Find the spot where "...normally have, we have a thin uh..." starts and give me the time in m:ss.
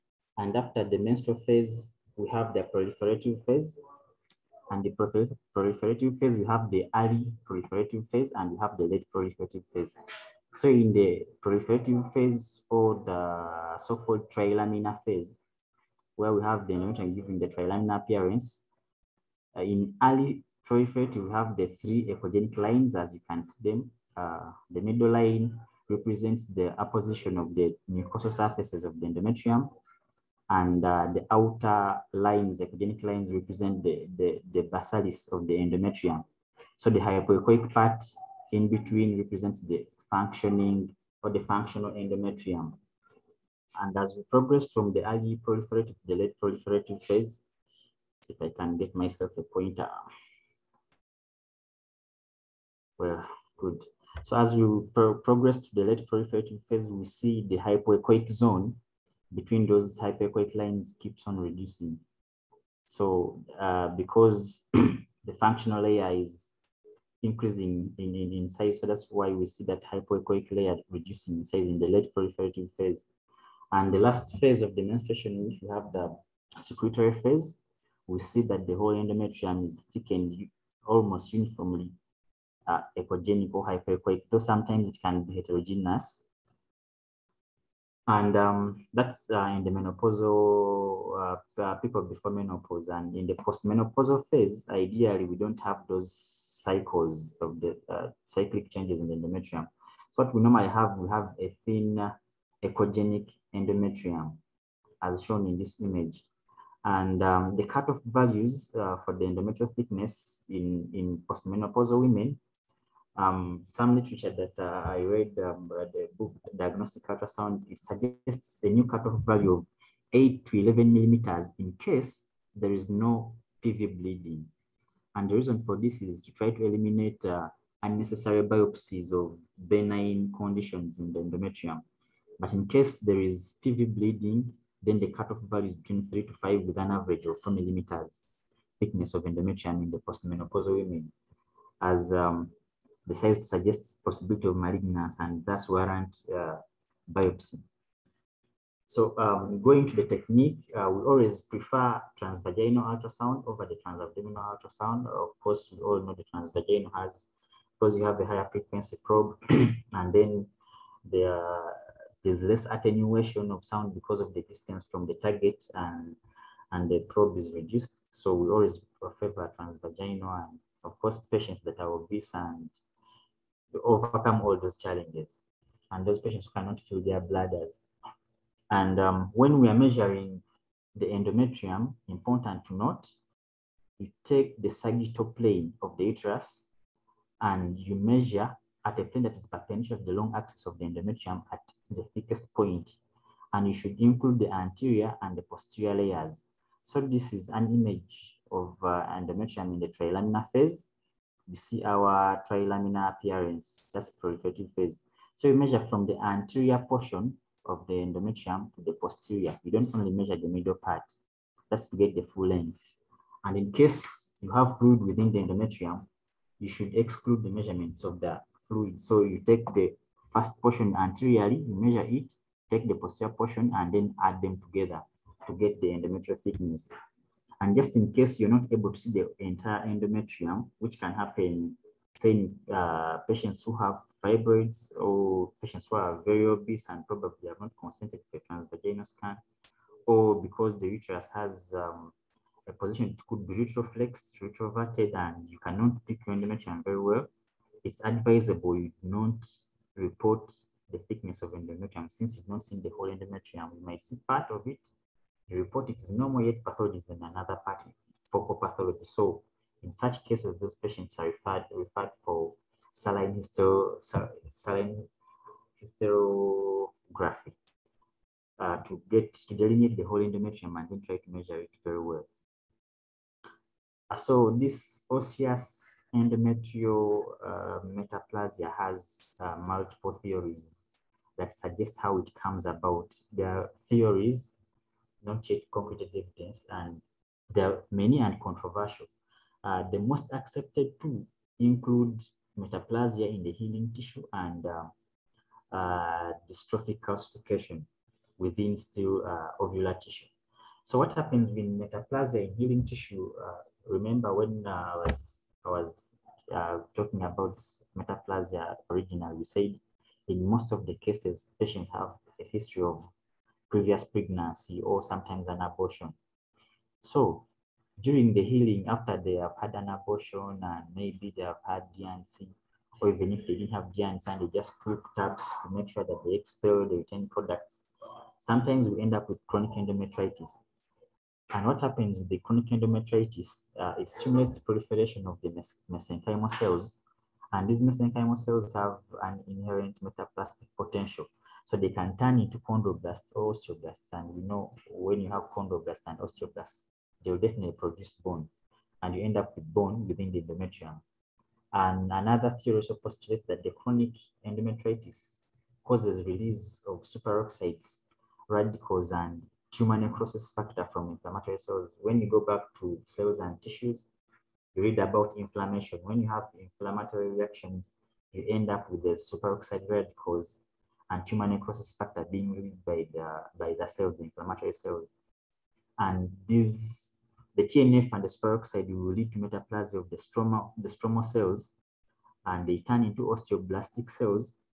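1:40.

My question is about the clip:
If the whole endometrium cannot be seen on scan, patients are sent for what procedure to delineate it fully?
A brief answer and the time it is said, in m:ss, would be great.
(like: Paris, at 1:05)
saline hysterography, at 4:24.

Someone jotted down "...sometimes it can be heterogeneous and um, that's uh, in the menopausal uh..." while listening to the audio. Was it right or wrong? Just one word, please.
right.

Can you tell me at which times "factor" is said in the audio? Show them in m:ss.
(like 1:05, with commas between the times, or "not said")
6:00, 6:11.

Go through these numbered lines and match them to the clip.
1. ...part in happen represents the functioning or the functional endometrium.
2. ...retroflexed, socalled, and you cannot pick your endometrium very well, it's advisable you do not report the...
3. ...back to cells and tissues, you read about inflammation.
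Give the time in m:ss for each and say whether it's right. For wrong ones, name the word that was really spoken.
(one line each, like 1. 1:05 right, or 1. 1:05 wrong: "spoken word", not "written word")
1. 0:37 wrong: "between", not "happen"
2. 4:03 wrong: "retroverted", not "socalled"
3. 6:02 right.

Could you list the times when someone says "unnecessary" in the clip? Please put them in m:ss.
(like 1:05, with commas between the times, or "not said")
2:07.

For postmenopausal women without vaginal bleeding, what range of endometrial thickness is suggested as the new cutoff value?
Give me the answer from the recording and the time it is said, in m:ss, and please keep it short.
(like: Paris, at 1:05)
8 to 11 millimeters, at 2:00.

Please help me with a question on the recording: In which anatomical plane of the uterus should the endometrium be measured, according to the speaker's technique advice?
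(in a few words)
sagittal plane.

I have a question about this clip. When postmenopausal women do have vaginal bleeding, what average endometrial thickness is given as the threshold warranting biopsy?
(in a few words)
4 millimeters.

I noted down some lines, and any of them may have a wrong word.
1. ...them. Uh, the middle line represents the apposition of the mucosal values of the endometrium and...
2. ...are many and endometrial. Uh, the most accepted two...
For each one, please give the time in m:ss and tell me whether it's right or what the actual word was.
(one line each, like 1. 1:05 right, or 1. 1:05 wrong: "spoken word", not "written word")
1. 0:23 wrong: "surfaces", not "values"
2. 4:47 wrong: "controversial", not "endometrial".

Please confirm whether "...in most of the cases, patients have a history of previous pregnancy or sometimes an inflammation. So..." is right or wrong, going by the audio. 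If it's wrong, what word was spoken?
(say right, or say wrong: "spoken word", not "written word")
wrong: "abortion", not "inflammation".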